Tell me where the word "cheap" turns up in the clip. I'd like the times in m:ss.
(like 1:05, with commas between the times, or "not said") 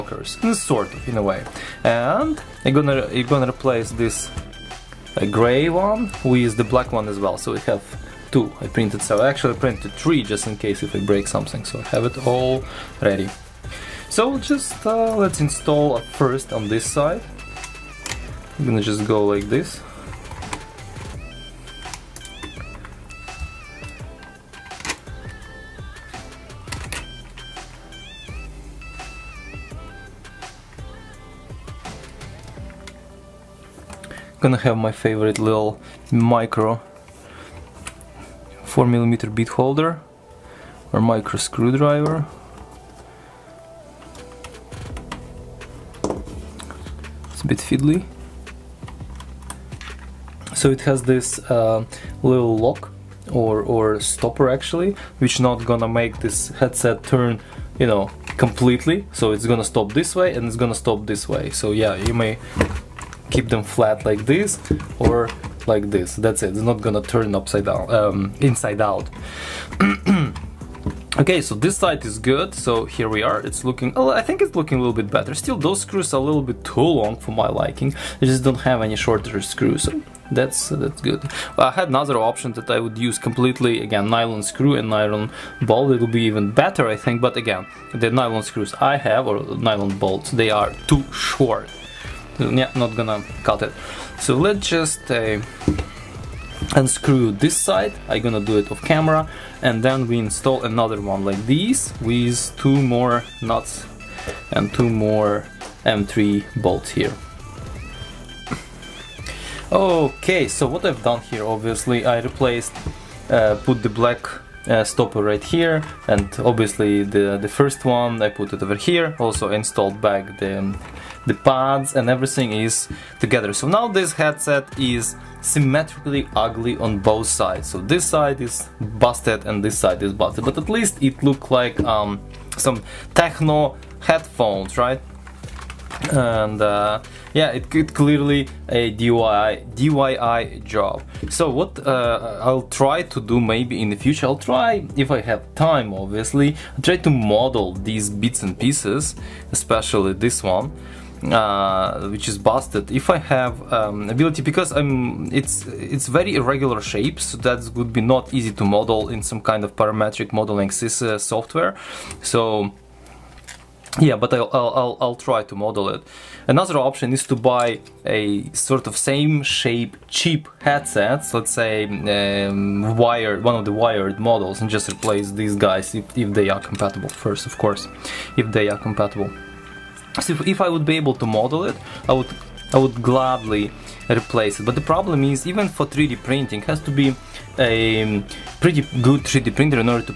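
2:50.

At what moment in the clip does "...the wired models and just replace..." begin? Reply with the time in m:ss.
2:53.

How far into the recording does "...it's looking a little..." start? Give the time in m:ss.
1:14.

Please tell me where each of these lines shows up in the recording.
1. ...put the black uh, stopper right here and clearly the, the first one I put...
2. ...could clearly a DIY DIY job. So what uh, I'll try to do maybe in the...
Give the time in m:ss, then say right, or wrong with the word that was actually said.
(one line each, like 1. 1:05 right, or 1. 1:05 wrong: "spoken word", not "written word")
1. 1:53 wrong: "obviously", not "clearly"
2. 2:17 right.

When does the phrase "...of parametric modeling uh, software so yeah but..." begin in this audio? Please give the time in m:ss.
2:39.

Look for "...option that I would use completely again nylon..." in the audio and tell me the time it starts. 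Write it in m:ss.
1:22.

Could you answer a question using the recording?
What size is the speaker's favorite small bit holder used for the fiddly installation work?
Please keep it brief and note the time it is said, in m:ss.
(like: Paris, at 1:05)
4mm, at 0:38.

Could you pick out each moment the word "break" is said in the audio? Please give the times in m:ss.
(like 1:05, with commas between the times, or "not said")
0:11.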